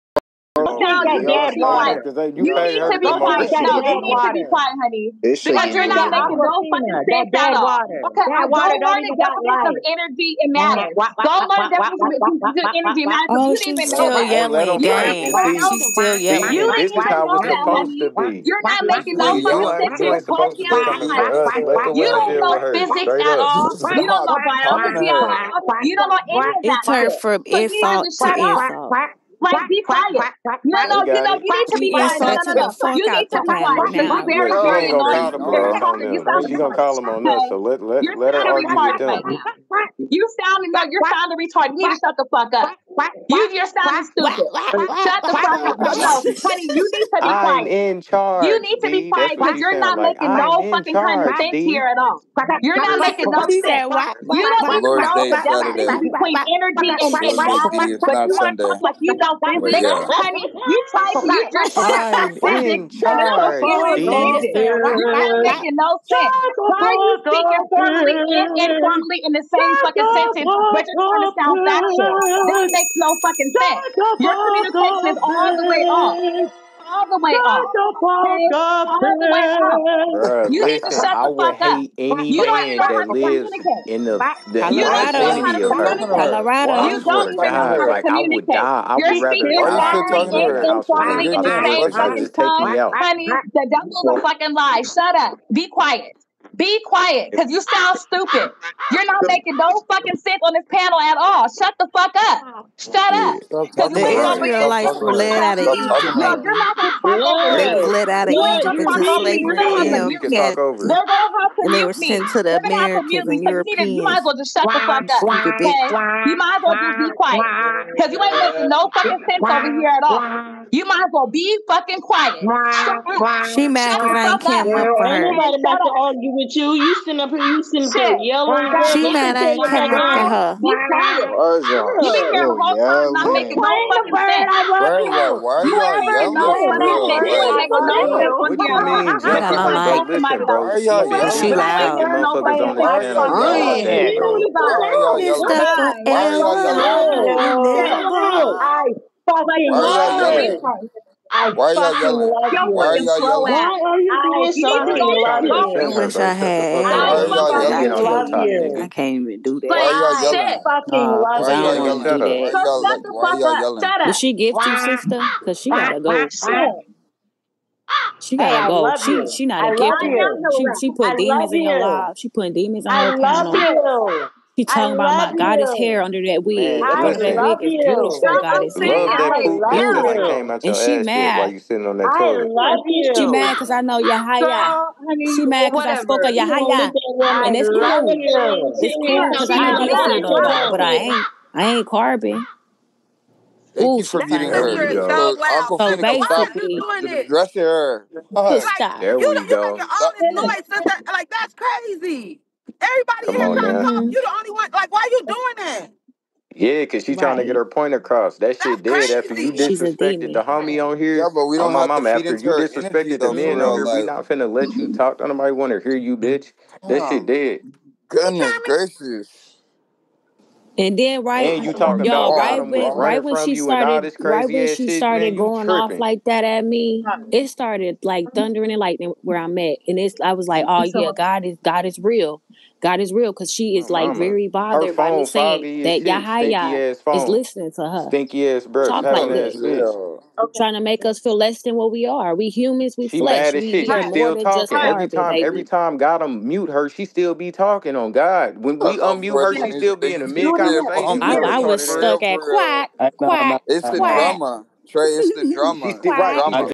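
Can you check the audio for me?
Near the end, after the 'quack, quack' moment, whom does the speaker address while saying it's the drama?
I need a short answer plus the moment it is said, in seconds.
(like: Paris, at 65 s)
Trey, at 254 s.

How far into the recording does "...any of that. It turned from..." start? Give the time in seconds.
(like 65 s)
26 s.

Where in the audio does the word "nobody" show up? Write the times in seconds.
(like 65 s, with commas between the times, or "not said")
125 s, 215 s.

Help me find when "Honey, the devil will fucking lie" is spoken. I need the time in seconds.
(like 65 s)
92 s.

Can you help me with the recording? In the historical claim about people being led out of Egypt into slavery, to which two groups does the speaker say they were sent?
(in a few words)
Americans and Europeans.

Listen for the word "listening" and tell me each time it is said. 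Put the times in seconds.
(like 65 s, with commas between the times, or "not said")
189 s, 237 s.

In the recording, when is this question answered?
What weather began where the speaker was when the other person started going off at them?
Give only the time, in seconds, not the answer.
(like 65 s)
228 s.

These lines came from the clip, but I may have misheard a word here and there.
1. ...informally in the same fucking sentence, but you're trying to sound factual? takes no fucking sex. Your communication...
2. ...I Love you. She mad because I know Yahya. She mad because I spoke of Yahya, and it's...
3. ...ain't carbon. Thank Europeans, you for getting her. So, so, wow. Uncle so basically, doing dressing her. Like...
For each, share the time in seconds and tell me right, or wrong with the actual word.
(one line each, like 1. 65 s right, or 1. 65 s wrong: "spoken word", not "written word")
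1. 68 s right
2. 182 s right
3. 191 s wrong: "Ooh", not "Europeans".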